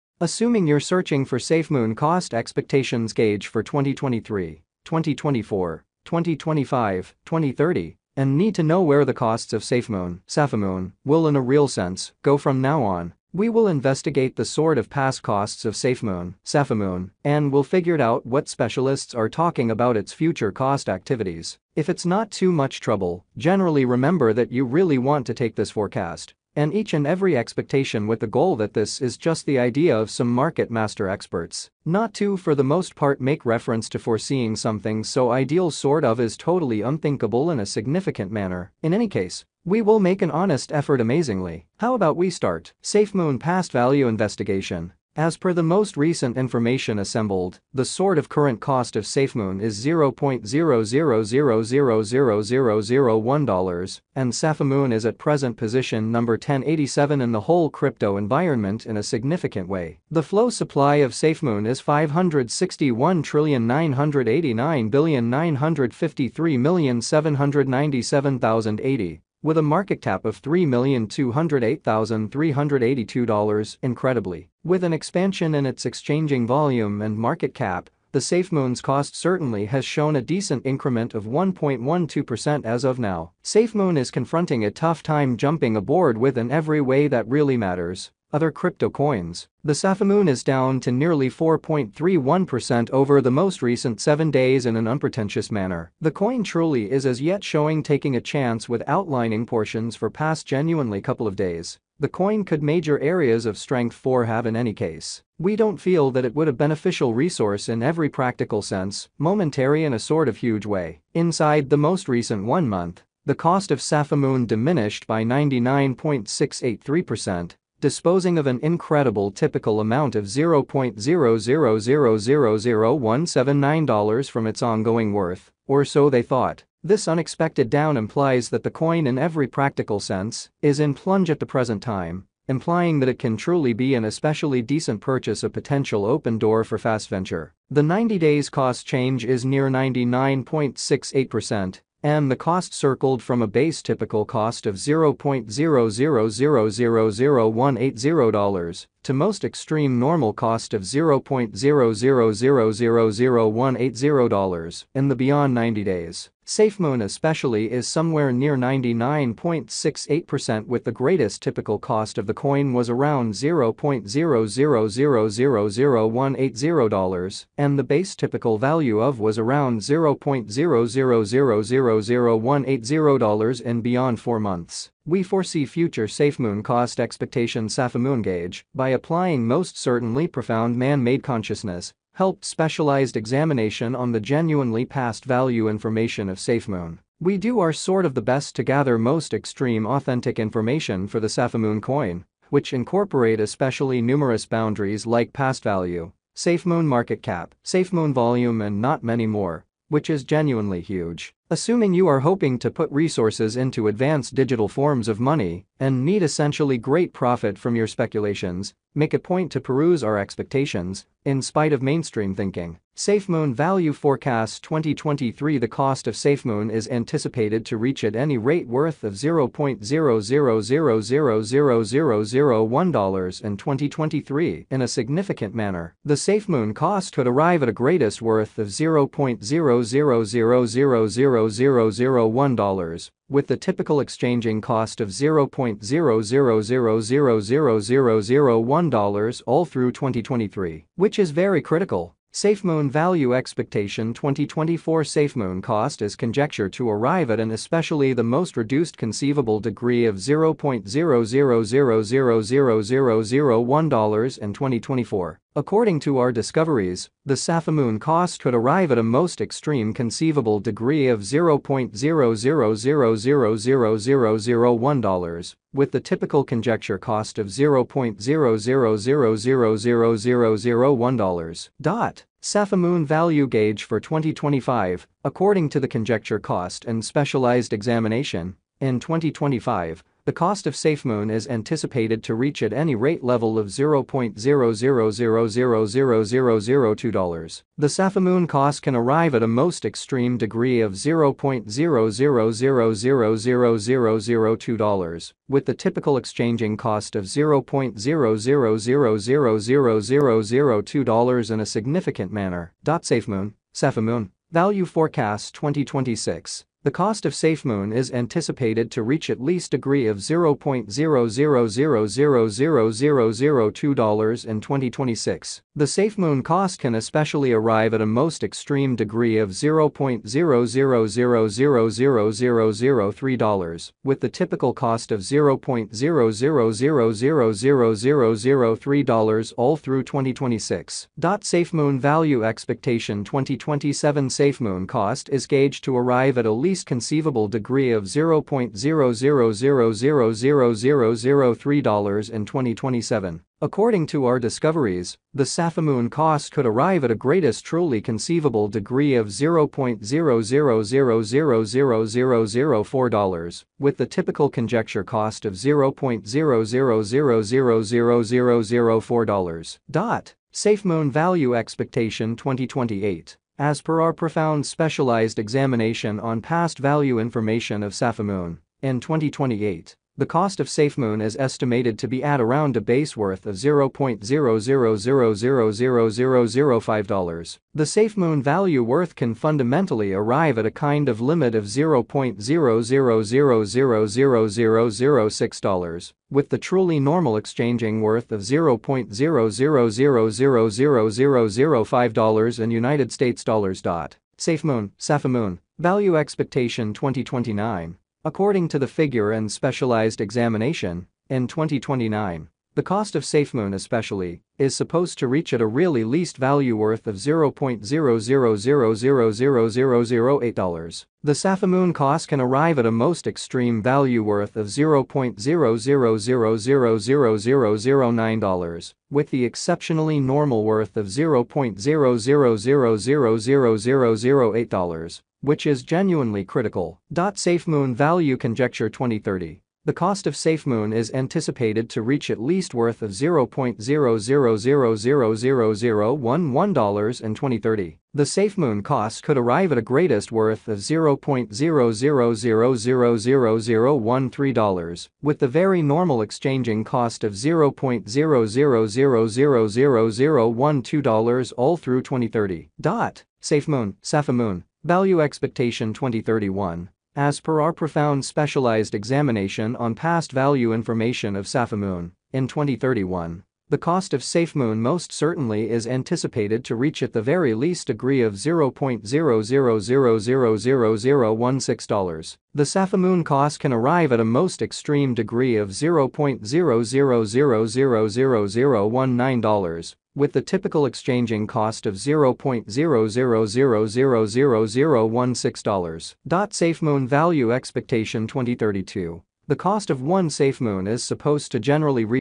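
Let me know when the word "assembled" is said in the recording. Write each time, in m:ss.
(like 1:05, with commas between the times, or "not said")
0:46.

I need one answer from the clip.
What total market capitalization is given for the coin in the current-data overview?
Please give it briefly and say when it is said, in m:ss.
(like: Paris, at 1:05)
$3,208,382, at 1:09.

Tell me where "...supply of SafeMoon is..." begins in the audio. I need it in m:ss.
1:00.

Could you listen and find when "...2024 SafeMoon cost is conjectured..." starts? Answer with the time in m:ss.
4:04.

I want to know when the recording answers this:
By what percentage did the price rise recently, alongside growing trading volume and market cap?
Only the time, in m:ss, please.
1:21.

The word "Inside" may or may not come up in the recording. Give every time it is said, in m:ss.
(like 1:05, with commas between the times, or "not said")
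1:51.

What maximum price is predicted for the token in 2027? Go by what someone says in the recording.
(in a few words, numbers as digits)
$0.000000004.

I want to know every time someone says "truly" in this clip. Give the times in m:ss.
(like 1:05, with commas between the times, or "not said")
1:36, 2:13, 5:47, 6:26.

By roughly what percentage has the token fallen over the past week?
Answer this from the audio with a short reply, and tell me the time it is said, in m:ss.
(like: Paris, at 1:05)
4.31%, at 1:31.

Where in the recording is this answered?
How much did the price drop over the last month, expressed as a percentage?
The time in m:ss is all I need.
1:55.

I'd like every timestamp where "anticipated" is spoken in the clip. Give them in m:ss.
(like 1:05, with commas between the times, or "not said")
3:36, 4:41, 5:08, 7:11, 7:45.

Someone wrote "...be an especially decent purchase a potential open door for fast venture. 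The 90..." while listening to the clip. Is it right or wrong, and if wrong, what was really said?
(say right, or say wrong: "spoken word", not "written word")
right.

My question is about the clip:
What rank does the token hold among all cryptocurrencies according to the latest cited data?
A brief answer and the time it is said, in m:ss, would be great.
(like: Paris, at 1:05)
1087, at 0:55.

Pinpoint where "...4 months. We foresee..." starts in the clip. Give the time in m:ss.
2:54.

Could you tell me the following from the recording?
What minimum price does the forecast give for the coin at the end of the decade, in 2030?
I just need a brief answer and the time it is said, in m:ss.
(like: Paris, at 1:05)
$0.000000011, at 7:13.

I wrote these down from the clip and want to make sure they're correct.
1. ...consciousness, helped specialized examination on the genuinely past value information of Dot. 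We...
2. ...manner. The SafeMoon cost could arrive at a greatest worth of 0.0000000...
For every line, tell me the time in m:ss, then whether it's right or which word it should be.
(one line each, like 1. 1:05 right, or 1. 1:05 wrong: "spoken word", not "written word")
1. 3:01 wrong: "SafeMoon", not "Dot"
2. 3:45 right.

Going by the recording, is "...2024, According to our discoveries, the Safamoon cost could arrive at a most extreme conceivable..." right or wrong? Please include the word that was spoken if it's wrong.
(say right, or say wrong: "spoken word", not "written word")
right.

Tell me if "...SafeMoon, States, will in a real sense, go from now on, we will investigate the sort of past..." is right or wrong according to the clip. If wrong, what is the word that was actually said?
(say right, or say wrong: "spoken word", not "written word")
wrong: "Safamoon", not "States".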